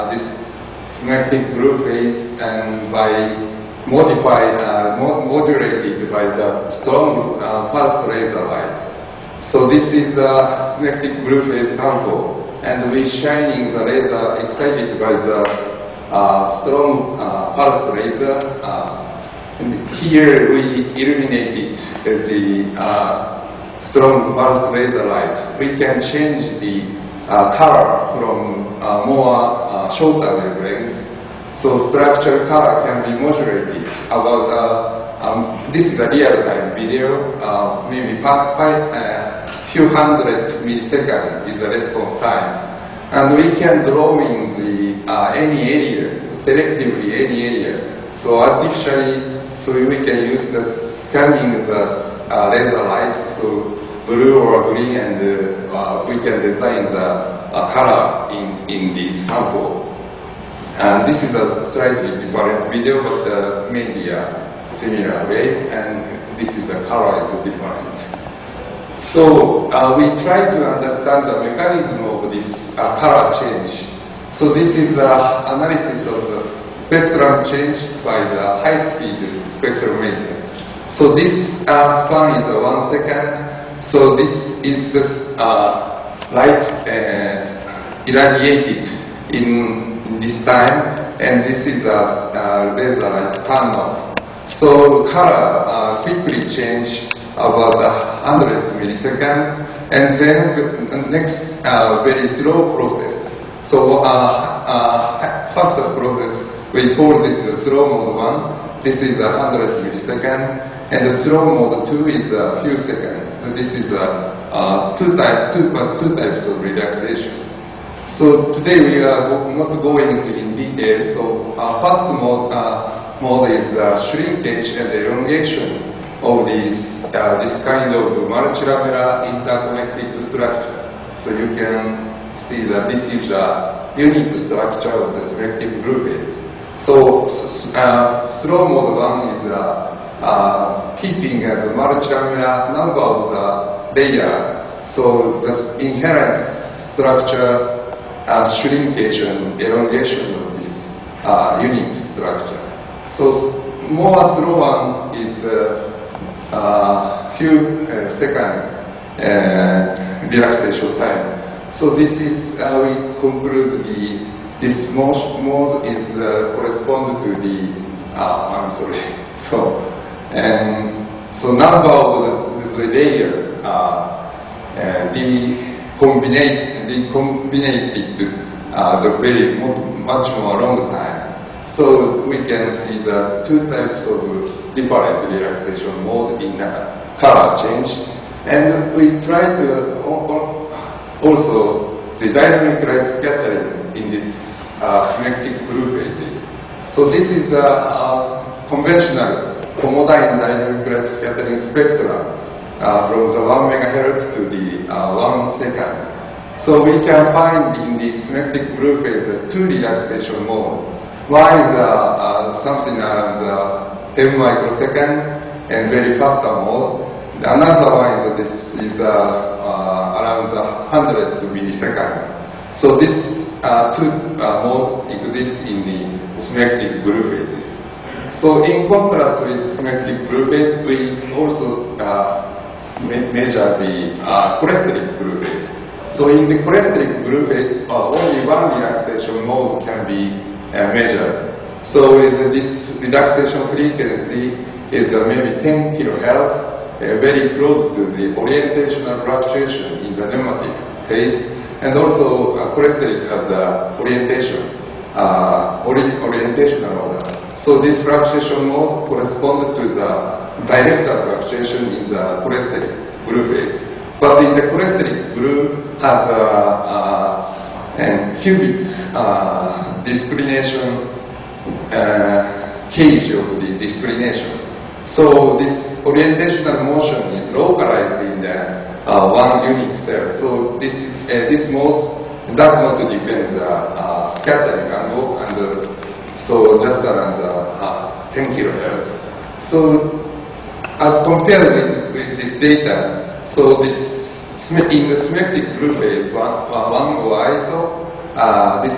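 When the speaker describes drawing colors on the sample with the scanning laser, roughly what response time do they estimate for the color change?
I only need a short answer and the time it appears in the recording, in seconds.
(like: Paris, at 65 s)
a few hundred milliseconds, at 38 s.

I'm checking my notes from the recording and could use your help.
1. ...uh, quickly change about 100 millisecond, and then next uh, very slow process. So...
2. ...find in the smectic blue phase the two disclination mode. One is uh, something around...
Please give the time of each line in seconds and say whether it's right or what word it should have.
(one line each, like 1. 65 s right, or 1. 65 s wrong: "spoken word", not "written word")
1. 95 s right
2. 207 s wrong: "relaxation", not "disclination".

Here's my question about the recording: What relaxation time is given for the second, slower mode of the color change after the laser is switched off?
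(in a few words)
a few seconds.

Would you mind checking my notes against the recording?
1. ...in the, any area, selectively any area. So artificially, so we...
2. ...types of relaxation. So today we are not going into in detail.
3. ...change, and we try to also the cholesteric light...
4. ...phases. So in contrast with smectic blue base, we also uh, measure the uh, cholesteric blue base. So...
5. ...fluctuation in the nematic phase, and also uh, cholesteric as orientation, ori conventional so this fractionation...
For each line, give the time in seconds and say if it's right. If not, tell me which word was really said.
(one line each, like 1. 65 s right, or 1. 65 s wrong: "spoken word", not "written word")
1. 44 s right
2. 116 s right
3. 187 s wrong: "dynamic", not "cholesteric"
4. 227 s right
5. 249 s wrong: "orientational", not "conventional".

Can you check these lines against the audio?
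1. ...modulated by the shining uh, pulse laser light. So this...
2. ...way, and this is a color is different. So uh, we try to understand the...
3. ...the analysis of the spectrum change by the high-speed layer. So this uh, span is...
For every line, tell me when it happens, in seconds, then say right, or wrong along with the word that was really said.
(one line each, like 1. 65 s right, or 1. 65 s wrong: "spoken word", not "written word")
1. 4 s wrong: "strong", not "shining"
2. 65 s right
3. 74 s wrong: "spectrometer", not "layer".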